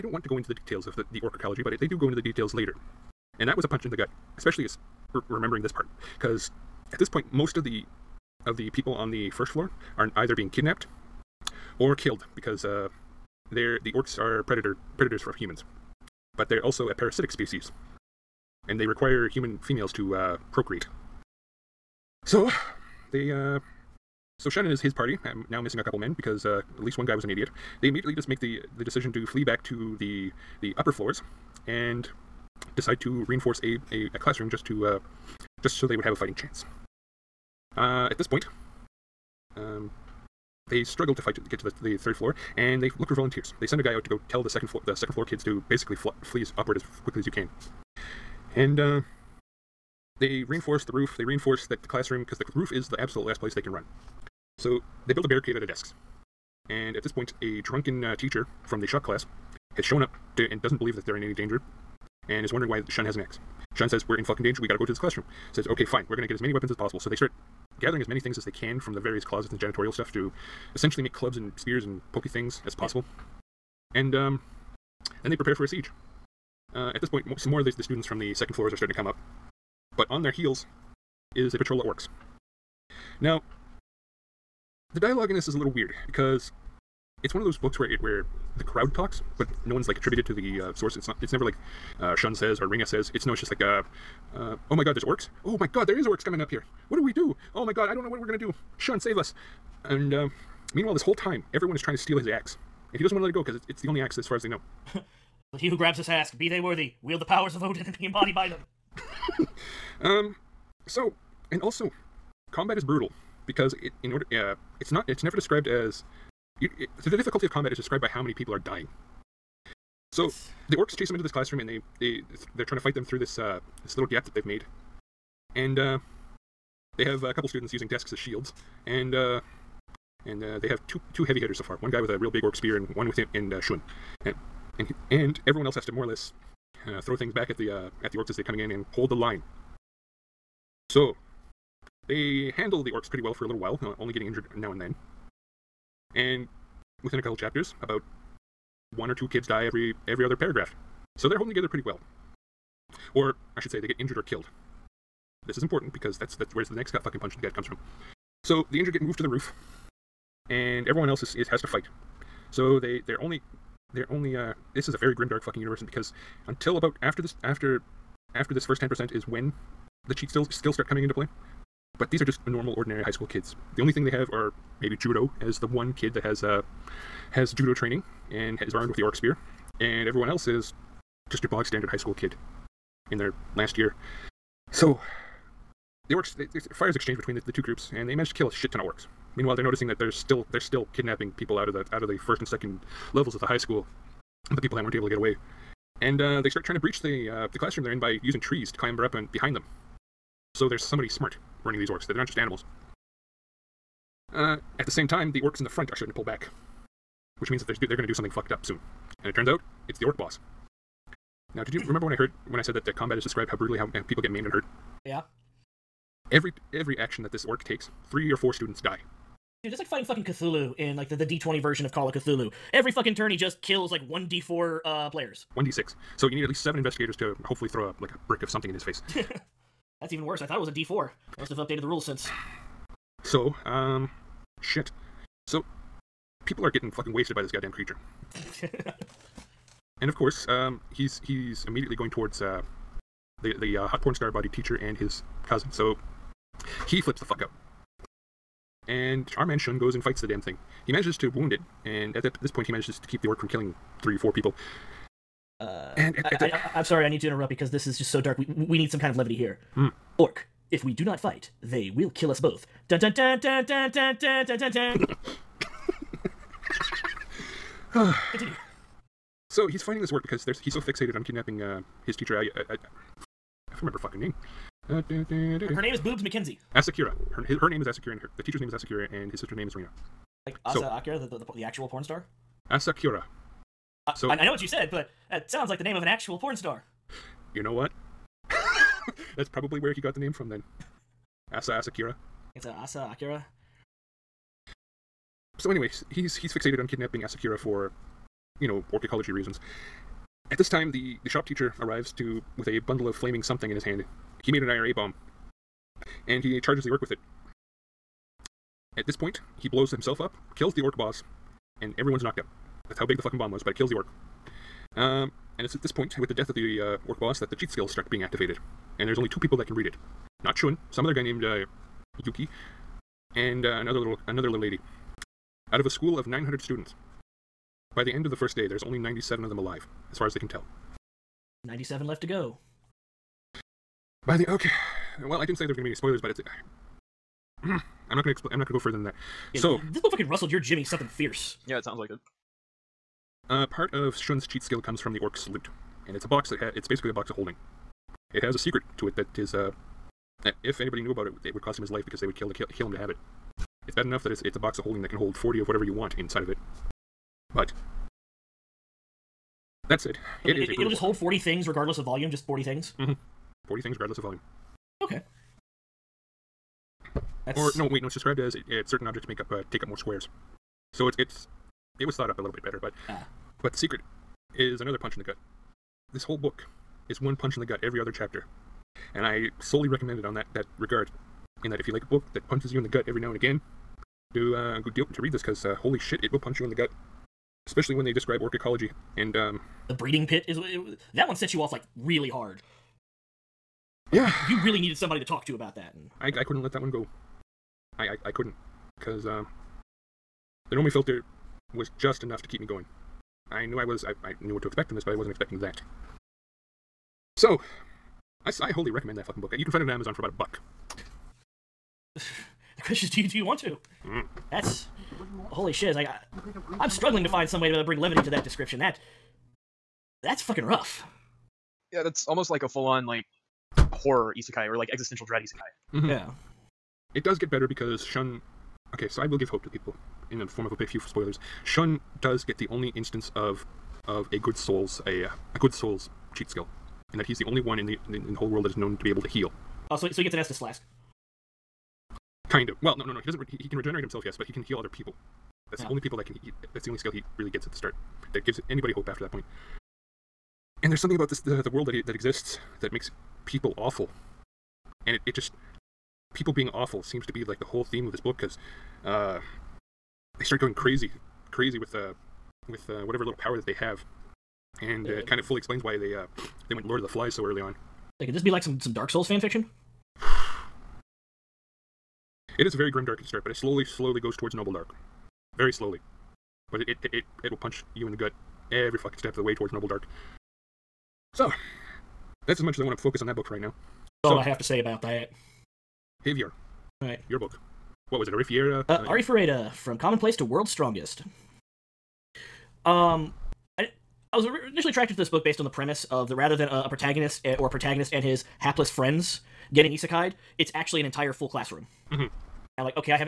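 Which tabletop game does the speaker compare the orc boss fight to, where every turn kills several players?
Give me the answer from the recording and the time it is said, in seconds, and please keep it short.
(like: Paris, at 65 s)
Call of Cthulhu, at 221 s.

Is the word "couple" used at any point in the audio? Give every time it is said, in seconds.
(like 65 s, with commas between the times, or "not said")
25 s, 127 s, 147 s.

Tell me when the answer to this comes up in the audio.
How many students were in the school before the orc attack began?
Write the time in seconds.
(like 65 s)
326 s.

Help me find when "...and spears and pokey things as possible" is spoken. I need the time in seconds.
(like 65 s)
71 s.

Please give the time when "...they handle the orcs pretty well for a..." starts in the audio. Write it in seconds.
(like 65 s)
142 s.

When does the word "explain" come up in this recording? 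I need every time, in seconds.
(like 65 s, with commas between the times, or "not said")
338 s, 465 s.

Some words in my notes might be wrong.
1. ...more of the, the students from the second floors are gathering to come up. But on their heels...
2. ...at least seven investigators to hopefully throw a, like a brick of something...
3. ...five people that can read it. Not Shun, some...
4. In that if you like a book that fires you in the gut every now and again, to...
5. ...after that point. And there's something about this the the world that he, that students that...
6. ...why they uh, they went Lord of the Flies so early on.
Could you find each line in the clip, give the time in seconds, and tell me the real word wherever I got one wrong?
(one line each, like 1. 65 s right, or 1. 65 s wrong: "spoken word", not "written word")
1. 77 s wrong: "starting", not "gathering"
2. 226 s right
3. 319 s wrong: "two", not "five"
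4. 381 s wrong: "punches", not "fires"
5. 449 s wrong: "exists", not "students"
6. 465 s right.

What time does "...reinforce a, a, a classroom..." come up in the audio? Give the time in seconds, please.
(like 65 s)
33 s.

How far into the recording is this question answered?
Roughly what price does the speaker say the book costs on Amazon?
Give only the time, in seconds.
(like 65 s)
410 s.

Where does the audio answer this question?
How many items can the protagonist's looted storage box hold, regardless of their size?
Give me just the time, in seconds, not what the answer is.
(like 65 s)
355 s.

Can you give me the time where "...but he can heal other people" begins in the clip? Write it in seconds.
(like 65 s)
444 s.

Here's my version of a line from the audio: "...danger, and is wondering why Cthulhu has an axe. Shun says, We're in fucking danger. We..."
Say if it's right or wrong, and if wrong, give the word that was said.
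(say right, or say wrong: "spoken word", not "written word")
wrong: "Shun", not "Cthulhu".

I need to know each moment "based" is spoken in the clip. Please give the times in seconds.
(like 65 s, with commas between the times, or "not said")
495 s.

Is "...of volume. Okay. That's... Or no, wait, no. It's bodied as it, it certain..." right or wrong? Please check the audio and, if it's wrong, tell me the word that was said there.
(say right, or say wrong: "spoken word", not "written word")
wrong: "described", not "bodied".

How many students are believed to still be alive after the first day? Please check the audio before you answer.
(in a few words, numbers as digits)
97.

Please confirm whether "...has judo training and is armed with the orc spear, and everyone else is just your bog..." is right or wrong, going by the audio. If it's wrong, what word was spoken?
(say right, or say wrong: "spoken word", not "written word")
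right.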